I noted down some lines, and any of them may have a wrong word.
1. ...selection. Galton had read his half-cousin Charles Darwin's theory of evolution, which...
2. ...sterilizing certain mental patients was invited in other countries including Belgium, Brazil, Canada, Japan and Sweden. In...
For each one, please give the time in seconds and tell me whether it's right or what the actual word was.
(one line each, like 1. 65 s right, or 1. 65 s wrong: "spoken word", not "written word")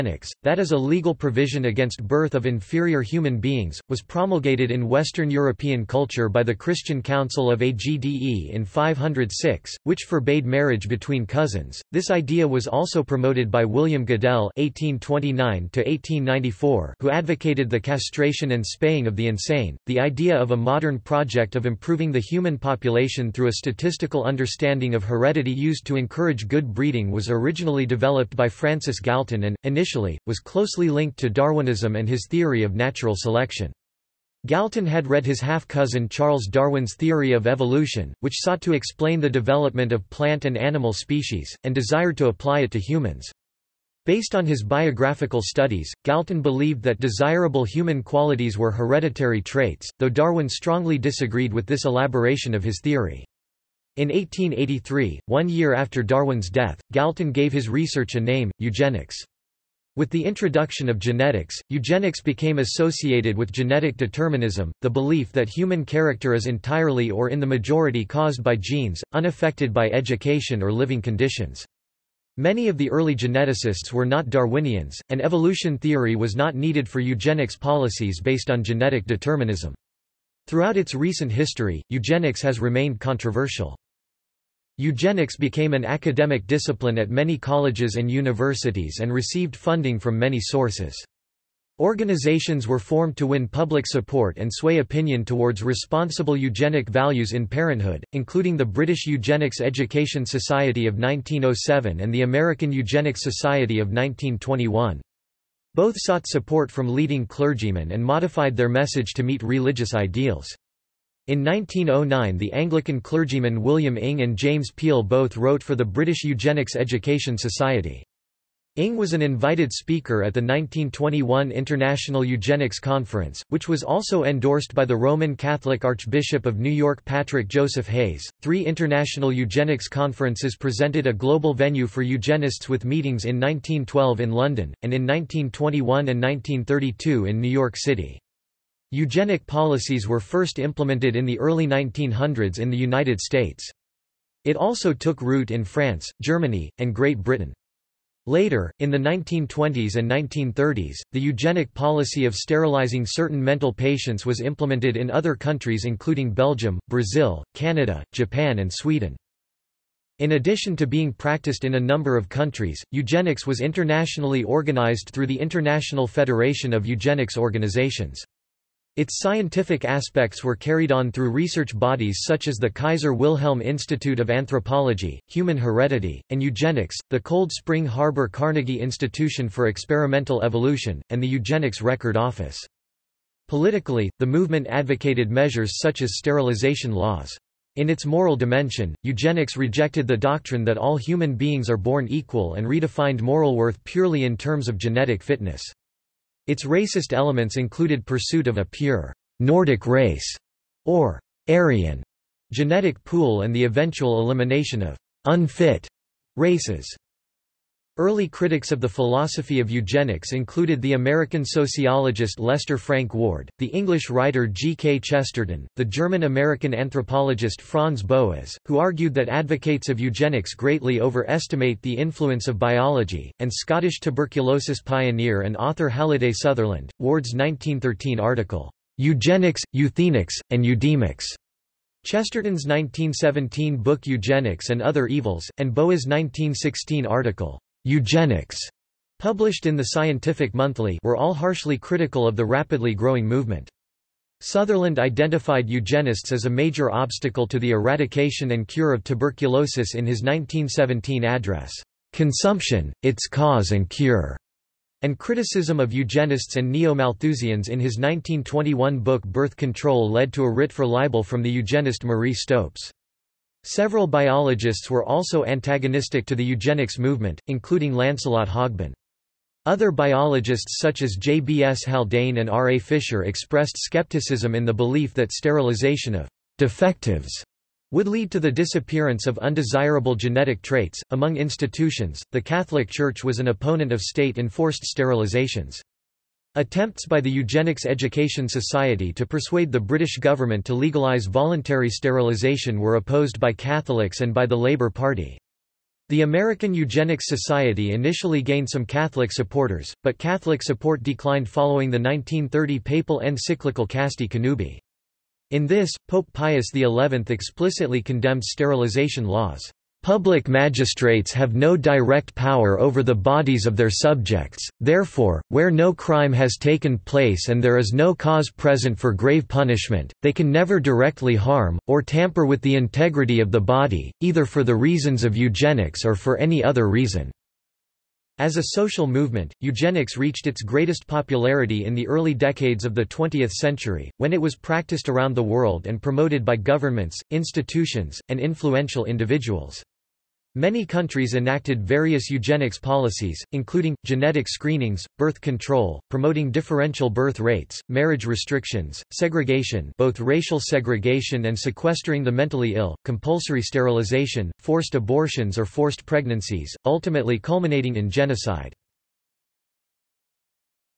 1. 33 s right
2. 152 s wrong: "implemented", not "invited".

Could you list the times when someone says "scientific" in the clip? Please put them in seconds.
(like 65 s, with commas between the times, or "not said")
169 s, 239 s.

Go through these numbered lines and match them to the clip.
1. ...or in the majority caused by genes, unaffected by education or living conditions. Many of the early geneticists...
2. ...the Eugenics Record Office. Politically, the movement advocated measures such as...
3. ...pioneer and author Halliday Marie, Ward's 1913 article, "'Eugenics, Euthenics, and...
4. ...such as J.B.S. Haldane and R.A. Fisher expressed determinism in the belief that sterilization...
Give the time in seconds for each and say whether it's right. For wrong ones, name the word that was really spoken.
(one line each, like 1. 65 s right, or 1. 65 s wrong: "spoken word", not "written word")
1. 67 s right
2. 181 s right
3. 224 s wrong: "Sutherland", not "Marie"
4. 270 s wrong: "skepticism", not "determinism".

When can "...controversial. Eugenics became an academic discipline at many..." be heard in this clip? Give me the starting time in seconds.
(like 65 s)
83 s.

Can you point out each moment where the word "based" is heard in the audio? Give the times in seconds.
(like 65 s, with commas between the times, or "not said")
44 s, 78 s.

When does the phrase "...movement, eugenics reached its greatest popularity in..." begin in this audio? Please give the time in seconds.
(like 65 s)
329 s.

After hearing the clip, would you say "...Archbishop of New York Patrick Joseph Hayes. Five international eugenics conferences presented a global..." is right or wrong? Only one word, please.
wrong.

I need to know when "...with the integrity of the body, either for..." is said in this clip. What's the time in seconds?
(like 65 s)
322 s.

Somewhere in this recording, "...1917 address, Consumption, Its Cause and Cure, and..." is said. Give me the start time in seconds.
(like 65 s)
250 s.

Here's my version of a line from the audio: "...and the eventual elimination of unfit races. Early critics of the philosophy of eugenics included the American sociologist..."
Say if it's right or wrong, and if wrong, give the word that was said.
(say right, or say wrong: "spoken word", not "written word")
right.